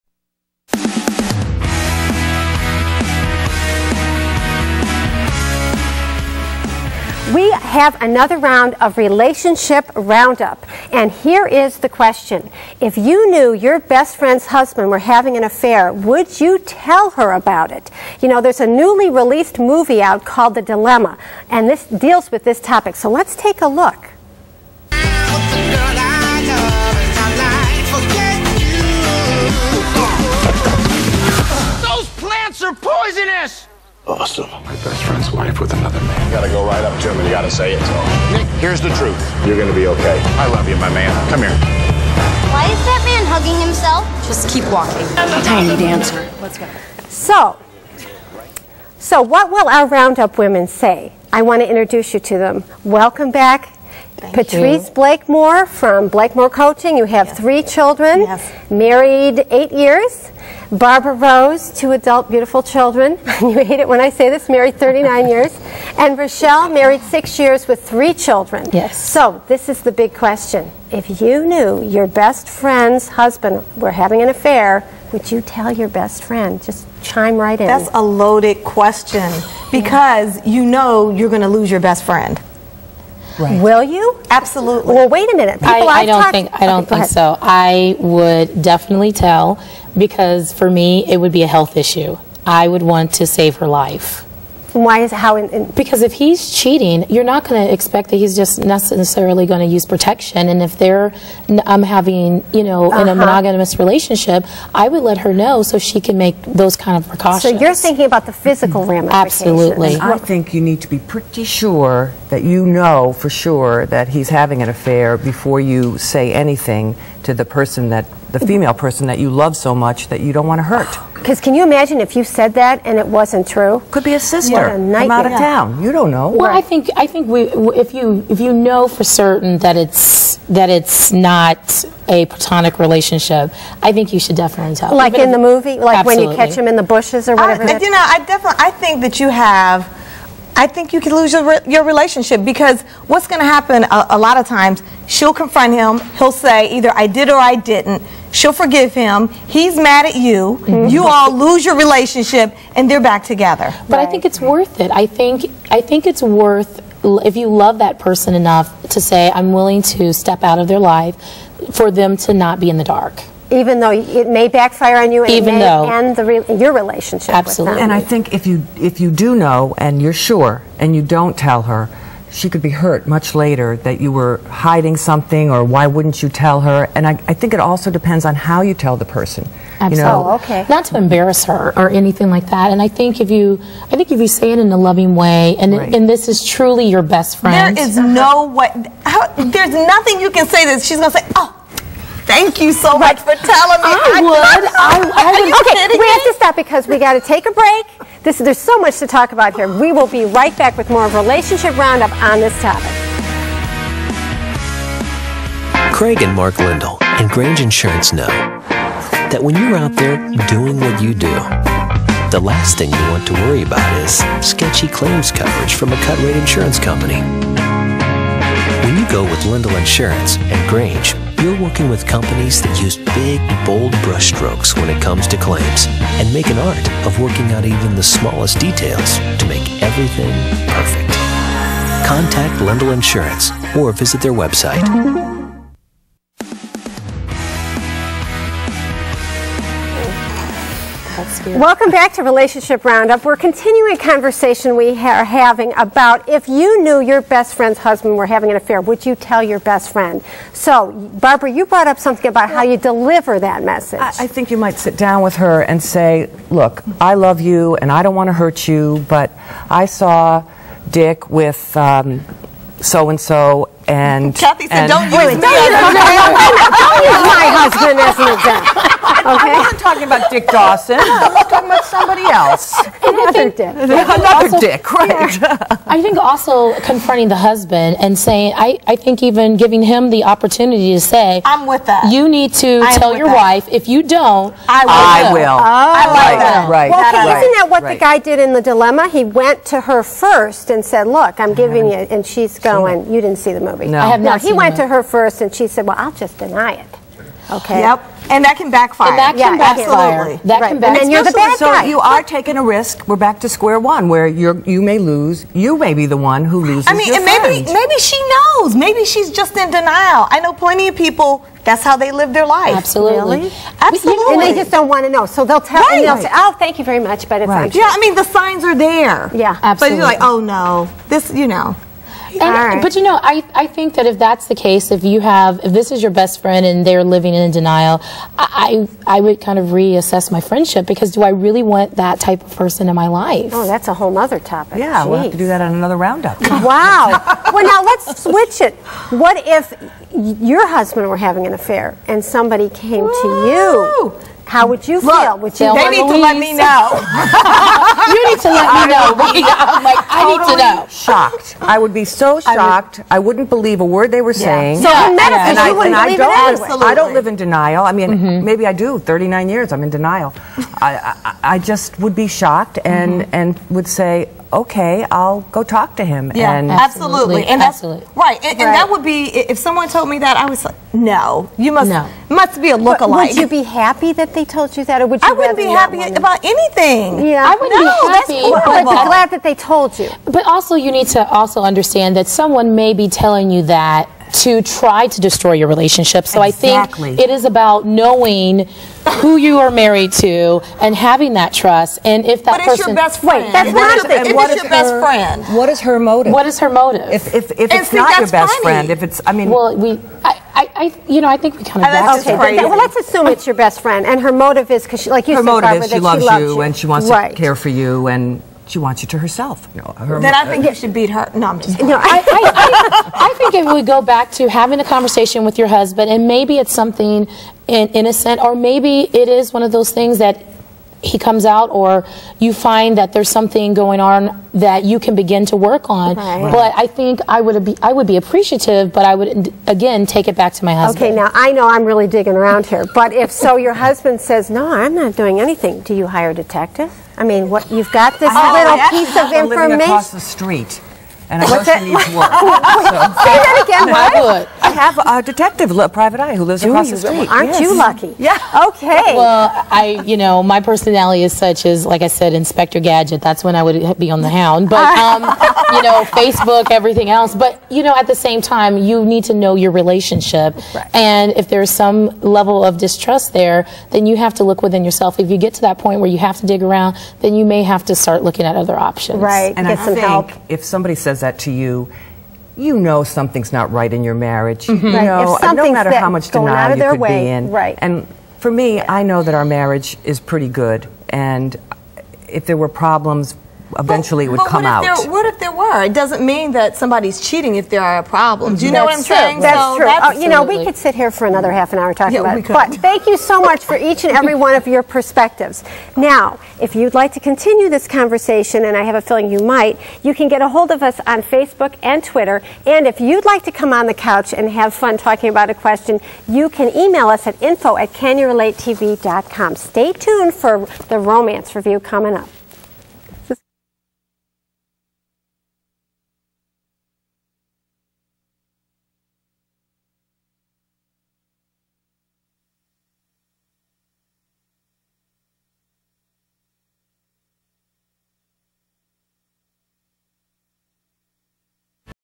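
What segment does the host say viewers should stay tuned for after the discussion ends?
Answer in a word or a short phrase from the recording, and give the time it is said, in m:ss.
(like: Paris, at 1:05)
Romance Review, at 8:30.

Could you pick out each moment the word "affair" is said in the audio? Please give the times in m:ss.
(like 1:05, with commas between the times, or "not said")
0:15, 1:14, 1:54, 4:08, 5:41.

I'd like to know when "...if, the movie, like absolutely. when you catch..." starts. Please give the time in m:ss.
2:15.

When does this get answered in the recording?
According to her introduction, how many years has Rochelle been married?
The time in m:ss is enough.
1:07.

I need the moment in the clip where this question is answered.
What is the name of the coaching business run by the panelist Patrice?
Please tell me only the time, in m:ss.
0:56.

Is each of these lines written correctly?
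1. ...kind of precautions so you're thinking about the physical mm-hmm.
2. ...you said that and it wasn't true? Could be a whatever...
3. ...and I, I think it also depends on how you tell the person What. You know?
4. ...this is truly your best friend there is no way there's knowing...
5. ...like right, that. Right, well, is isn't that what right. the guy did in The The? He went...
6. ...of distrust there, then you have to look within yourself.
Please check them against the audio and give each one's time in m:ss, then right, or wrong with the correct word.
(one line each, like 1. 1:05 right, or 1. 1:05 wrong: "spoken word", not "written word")
1. 1:46 right
2. 2:02 wrong: "sister", not "whatever"
3. 2:56 wrong: "Absolutely", not "What"
4. 3:06 wrong: "nothing", not "knowing"
5. 4:46 wrong: "Dilemma", not "The"
6. 7:42 right.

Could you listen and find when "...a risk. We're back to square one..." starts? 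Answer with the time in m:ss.
5:02.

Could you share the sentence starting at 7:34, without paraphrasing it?
But um, you know, Facebook, everything else.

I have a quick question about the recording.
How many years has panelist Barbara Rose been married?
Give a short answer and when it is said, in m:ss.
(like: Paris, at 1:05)
39, at 1:04.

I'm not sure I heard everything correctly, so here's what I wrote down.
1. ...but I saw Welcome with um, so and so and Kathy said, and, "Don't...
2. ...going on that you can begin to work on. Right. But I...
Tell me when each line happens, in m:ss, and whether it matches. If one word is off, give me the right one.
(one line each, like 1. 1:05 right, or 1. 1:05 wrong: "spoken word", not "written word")
1. 4:19 wrong: "Dick", not "Welcome"
2. 7:03 right.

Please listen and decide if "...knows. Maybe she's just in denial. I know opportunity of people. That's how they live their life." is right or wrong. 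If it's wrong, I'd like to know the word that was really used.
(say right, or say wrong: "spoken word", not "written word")
wrong: "plenty", not "opportunity".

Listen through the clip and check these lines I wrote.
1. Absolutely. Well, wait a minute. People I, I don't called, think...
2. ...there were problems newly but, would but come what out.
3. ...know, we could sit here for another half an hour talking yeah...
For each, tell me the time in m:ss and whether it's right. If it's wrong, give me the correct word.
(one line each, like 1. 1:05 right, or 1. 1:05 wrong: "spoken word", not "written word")
1. 1:24 wrong: "talked", not "called"
2. 8:02 wrong: "eventually", not "newly"
3. 8:10 right.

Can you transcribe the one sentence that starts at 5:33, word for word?
Oh, that's a whole other topic.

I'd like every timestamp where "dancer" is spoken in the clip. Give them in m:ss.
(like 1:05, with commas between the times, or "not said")
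0:45.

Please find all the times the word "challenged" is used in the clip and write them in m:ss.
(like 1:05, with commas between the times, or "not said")
not said.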